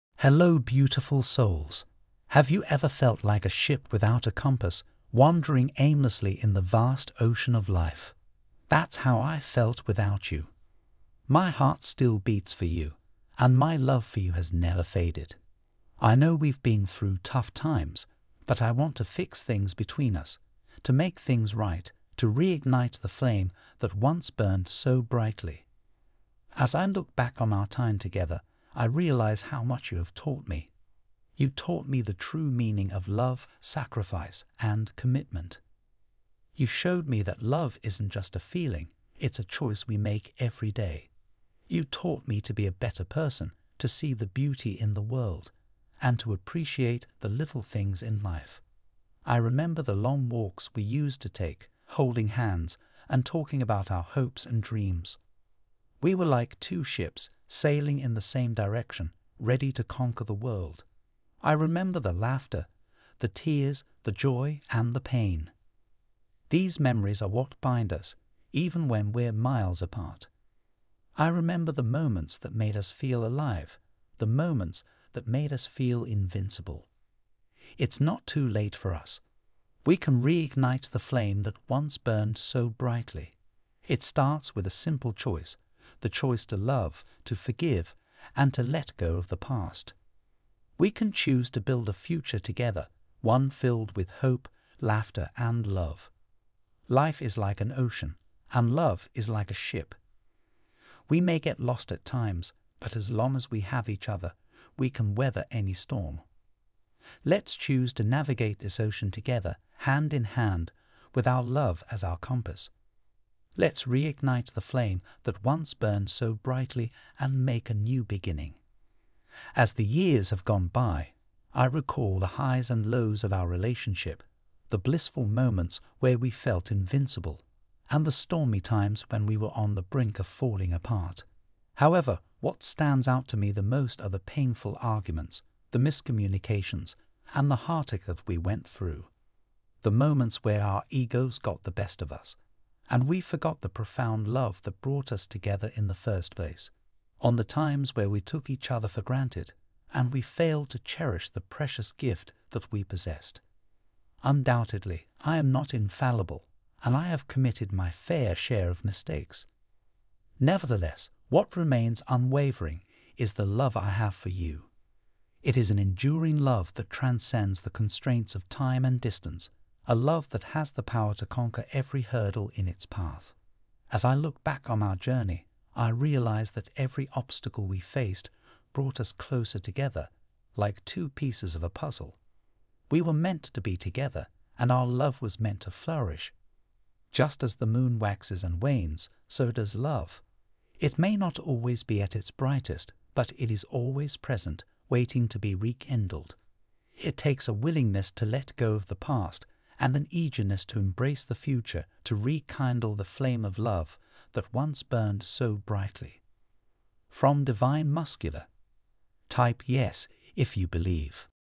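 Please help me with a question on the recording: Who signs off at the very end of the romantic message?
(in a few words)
Divine Masculine.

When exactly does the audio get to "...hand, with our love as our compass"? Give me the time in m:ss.
1:50.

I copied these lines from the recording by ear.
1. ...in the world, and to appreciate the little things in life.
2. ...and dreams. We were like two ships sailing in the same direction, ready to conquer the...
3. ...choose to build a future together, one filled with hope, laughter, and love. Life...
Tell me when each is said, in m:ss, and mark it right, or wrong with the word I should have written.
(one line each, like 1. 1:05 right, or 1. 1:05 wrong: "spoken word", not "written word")
1. 0:44 right
2. 0:54 right
3. 1:31 right.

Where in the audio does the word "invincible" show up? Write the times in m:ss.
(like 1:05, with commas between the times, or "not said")
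1:16, 2:06.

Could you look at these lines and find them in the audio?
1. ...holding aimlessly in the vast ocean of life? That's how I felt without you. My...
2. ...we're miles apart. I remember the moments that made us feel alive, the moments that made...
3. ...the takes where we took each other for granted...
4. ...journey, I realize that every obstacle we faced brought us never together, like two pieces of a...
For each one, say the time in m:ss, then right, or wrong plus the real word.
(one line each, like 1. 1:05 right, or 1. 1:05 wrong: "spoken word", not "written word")
1. 0:05 wrong: "wandering", not "holding"
2. 1:09 right
3. 2:27 wrong: "times", not "takes"
4. 2:54 wrong: "closer", not "never".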